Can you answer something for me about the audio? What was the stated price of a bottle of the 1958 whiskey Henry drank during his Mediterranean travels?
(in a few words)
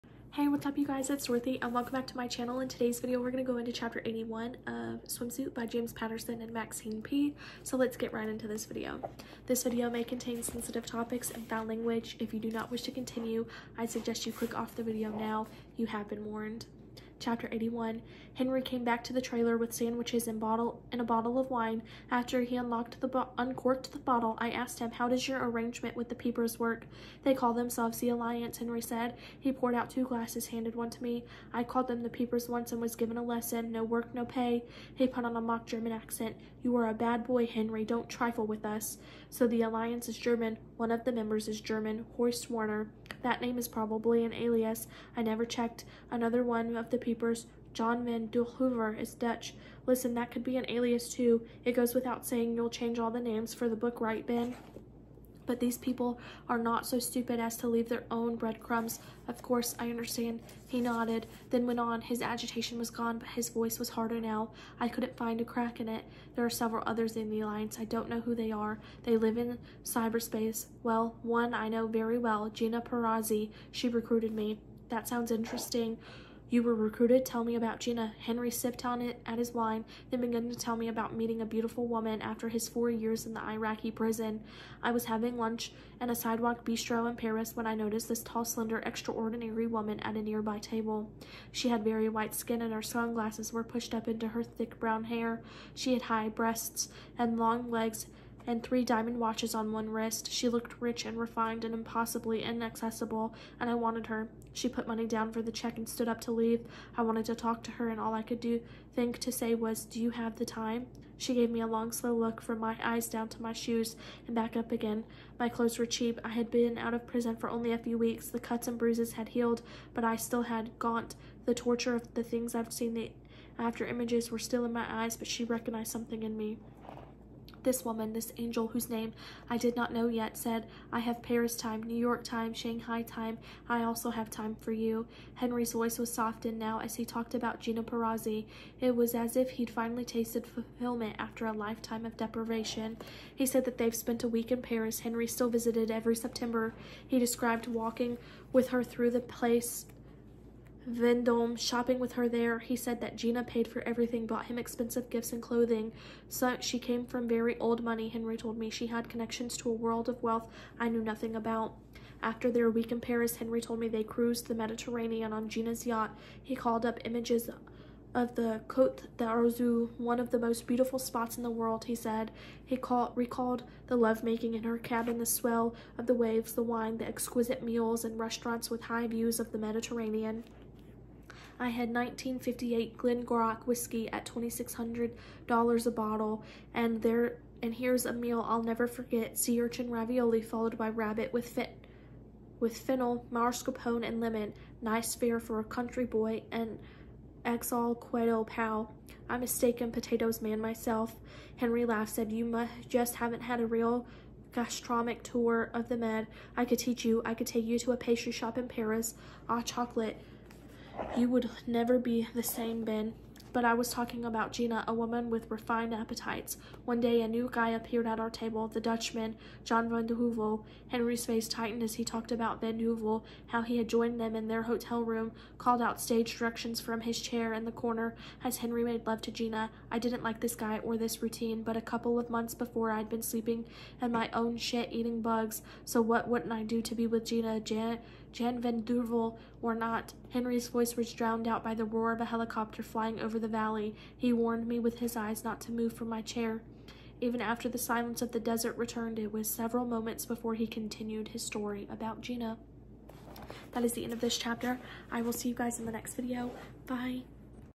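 $2,600.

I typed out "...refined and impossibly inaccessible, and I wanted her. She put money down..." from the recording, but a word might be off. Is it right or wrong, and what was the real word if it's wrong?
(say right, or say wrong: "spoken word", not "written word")
right.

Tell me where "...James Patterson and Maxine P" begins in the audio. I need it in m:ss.
0:05.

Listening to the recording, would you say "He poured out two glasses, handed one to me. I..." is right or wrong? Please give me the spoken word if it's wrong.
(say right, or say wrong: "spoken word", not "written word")
right.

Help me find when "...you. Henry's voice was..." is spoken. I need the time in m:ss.
2:14.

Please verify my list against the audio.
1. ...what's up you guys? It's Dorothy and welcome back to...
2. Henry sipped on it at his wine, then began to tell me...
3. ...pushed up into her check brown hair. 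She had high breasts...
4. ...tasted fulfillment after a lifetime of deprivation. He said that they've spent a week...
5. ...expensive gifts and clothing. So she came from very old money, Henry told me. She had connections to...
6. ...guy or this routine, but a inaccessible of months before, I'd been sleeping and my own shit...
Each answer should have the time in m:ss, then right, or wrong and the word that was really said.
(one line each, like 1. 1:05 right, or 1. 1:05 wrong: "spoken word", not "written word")
1. 0:00 right
2. 1:18 right
3. 1:33 wrong: "thick", not "check"
4. 2:20 right
5. 2:34 right
6. 3:50 wrong: "couple", not "inaccessible".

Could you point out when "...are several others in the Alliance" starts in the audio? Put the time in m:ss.
1:06.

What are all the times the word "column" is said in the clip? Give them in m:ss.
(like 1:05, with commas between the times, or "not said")
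not said.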